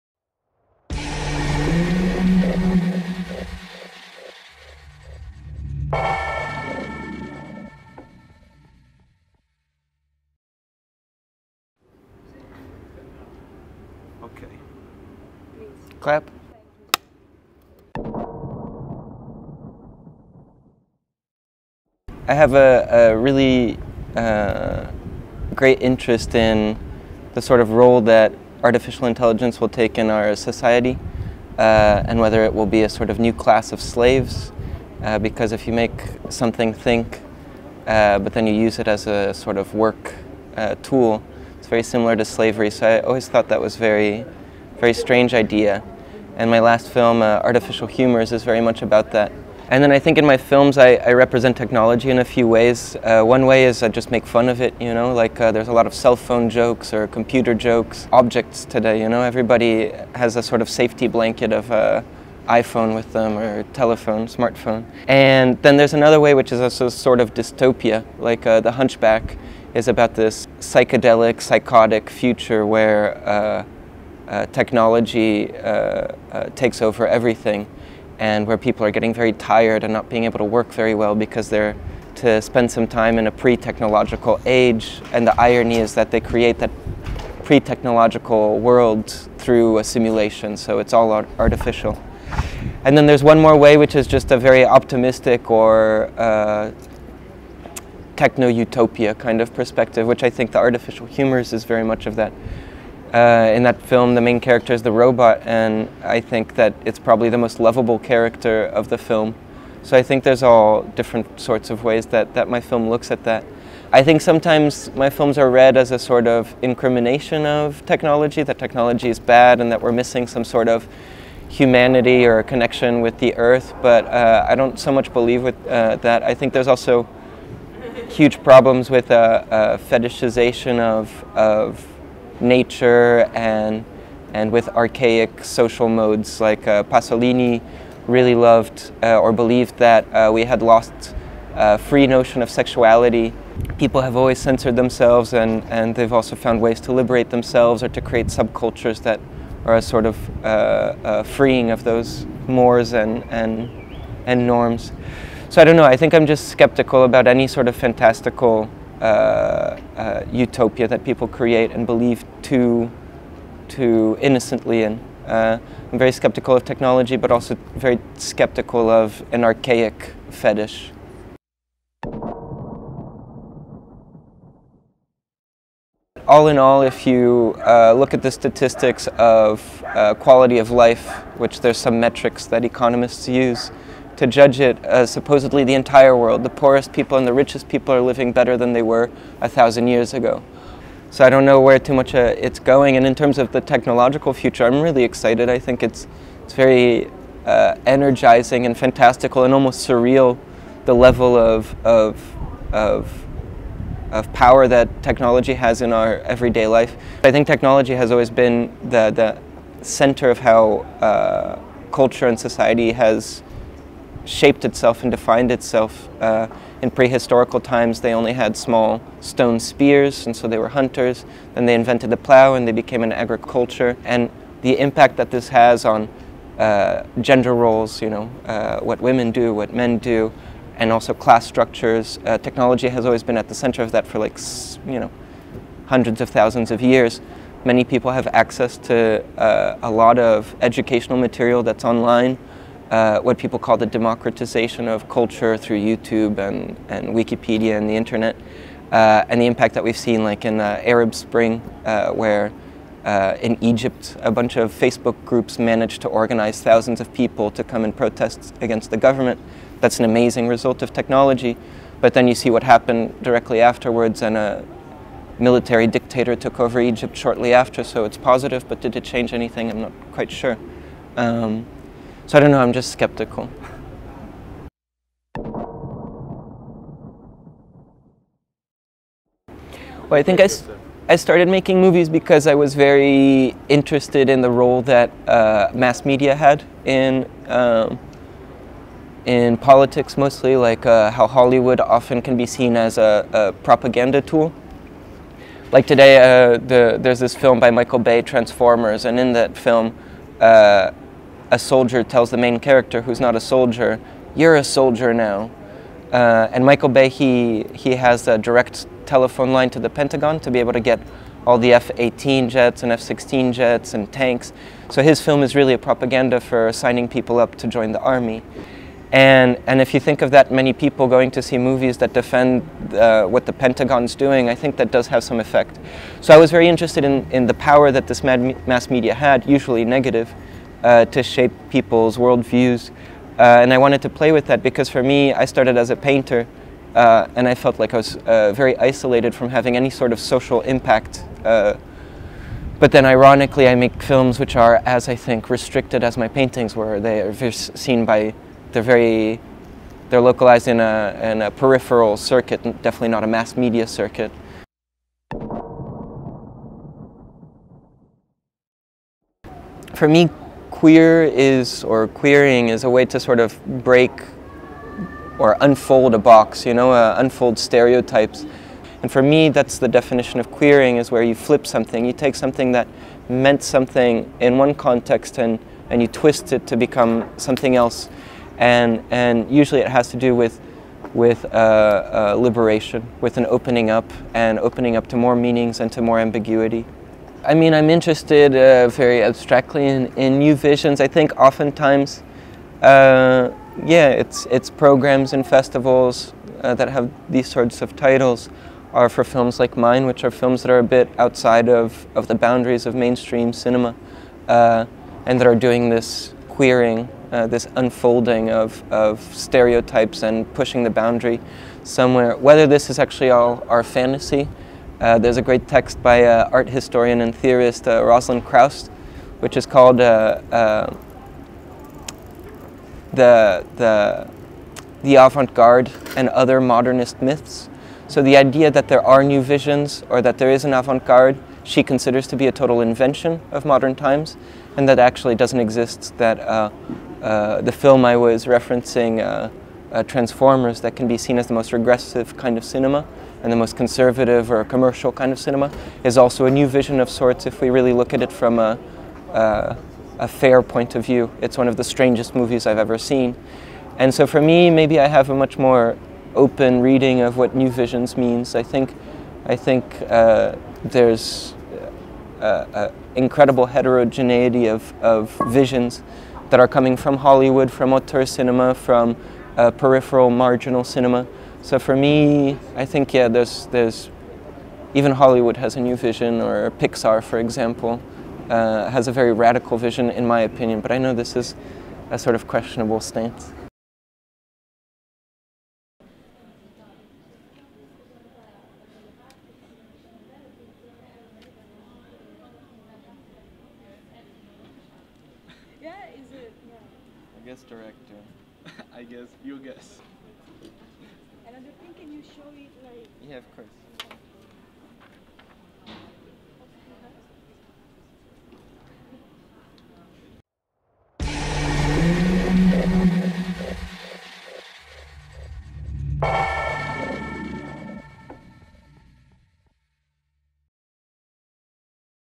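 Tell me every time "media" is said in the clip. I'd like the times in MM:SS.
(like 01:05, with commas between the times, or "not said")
04:46, 05:28, 05:53.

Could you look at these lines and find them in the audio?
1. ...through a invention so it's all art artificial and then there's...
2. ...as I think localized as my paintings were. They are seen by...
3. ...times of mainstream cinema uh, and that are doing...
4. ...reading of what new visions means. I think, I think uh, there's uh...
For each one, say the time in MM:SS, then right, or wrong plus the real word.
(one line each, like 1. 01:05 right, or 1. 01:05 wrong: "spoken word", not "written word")
1. 01:29 wrong: "simulation", not "invention"
2. 05:44 wrong: "restricted", not "localized"
3. 06:42 wrong: "boundaries", not "times"
4. 07:36 right.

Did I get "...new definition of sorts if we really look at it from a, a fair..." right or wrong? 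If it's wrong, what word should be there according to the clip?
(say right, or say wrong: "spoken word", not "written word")
wrong: "vision", not "definition".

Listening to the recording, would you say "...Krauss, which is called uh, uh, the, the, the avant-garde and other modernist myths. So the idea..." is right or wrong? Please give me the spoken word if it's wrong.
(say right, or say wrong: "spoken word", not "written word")
right.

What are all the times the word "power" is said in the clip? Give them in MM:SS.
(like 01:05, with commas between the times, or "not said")
03:24, 05:27.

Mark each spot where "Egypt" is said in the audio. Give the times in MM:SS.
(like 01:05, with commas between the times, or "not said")
04:13, 04:26.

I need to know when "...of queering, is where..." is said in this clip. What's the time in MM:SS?
06:10.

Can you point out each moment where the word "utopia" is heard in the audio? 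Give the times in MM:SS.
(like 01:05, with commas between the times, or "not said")
01:38, 02:40.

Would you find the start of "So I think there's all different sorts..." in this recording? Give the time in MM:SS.
01:49.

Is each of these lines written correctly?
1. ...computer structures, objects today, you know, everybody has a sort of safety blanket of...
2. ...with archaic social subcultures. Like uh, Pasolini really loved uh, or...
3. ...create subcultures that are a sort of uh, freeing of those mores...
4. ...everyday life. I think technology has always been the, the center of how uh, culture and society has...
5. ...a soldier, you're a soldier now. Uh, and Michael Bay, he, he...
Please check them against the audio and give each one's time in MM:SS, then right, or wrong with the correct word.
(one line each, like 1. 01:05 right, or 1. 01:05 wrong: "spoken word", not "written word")
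1. 00:57 wrong: "jokes", not "structures"
2. 02:14 wrong: "modes", not "subcultures"
3. 02:28 right
4. 03:26 right
5. 05:03 right.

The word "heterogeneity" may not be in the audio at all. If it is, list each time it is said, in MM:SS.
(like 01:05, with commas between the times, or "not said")
07:43.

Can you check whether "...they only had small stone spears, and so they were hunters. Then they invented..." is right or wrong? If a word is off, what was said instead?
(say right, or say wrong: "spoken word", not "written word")
right.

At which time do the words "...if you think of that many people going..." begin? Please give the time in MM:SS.
05:19.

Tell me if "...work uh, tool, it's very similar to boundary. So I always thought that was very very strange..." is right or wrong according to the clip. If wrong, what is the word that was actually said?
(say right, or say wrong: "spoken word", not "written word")
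wrong: "slavery", not "boundary".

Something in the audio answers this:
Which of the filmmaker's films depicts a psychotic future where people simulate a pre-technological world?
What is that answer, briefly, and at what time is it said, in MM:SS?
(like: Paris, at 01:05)
The Hunchback, at 01:08.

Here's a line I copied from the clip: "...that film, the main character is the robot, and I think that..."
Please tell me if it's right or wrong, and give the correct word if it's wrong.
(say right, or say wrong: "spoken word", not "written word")
right.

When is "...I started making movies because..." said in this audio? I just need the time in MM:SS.
04:41.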